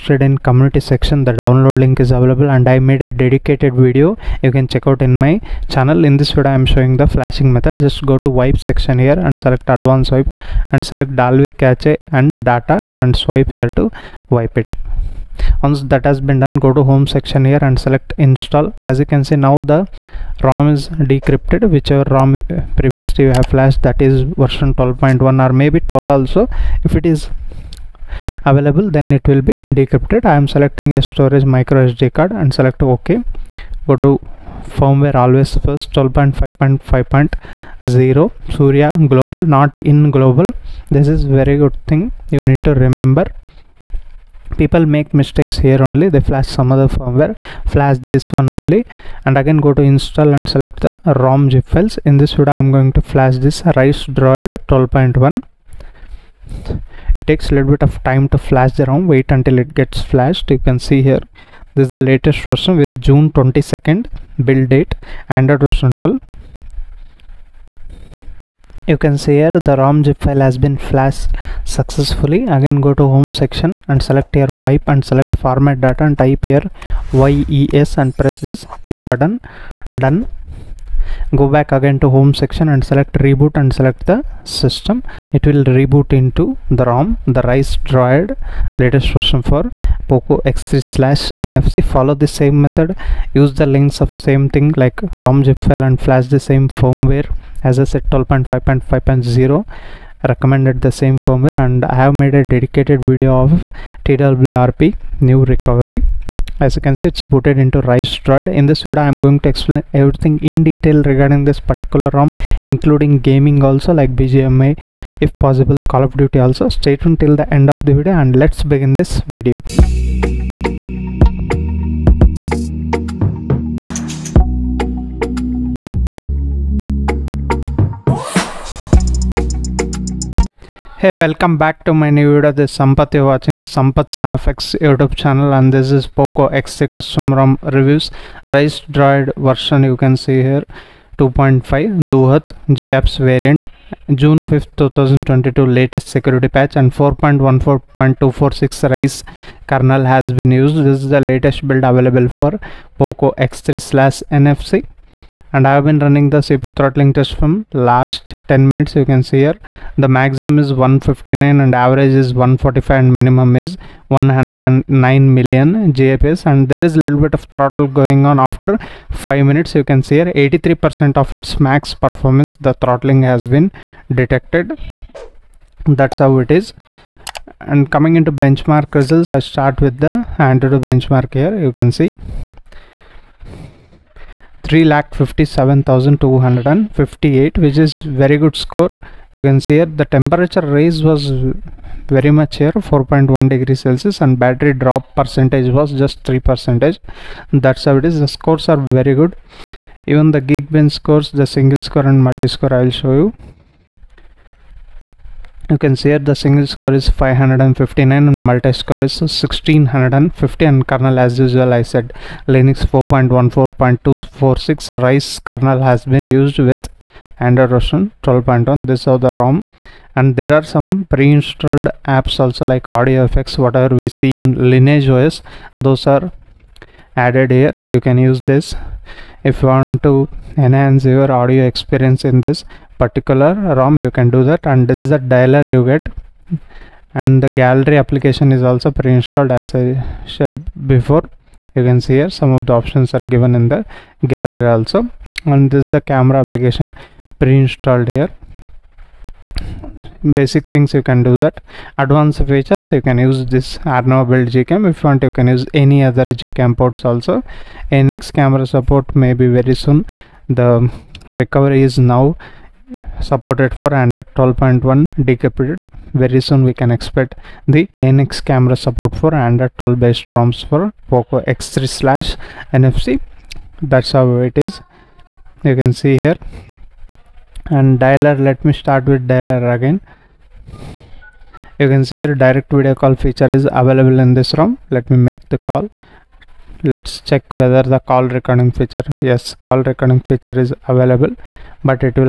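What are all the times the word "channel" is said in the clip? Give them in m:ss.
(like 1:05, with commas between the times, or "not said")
0:05, 2:15.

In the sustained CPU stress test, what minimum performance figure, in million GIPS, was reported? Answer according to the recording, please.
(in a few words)
109.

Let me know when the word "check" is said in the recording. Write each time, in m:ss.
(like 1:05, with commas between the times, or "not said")
0:04, 4:47.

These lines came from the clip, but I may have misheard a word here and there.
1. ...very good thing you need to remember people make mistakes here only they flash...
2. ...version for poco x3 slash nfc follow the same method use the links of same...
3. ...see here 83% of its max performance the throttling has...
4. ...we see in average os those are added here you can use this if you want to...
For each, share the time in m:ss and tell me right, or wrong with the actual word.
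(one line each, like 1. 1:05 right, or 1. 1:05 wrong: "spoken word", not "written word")
1. 0:41 right
2. 1:29 right
3. 2:50 right
4. 3:43 wrong: "lineage", not "average".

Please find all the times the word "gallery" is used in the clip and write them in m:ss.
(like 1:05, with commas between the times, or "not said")
3:57, 4:04.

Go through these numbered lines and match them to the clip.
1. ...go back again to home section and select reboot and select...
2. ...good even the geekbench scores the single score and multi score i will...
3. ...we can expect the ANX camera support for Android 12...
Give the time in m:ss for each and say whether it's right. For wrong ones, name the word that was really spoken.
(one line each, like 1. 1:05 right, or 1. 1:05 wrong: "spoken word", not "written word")
1. 1:21 right
2. 3:19 right
3. 4:26 right.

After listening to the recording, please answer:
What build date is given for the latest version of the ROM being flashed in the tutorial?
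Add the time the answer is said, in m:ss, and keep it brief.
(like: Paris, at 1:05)
June 22nd, at 1:03.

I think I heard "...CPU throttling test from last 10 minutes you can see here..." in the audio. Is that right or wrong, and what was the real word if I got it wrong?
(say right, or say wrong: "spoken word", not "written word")
right.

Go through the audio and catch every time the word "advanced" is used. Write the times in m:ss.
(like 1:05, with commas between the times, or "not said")
0:09, 4:11.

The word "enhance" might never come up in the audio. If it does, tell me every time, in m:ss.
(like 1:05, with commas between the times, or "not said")
3:50.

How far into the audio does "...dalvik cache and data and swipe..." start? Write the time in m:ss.
0:11.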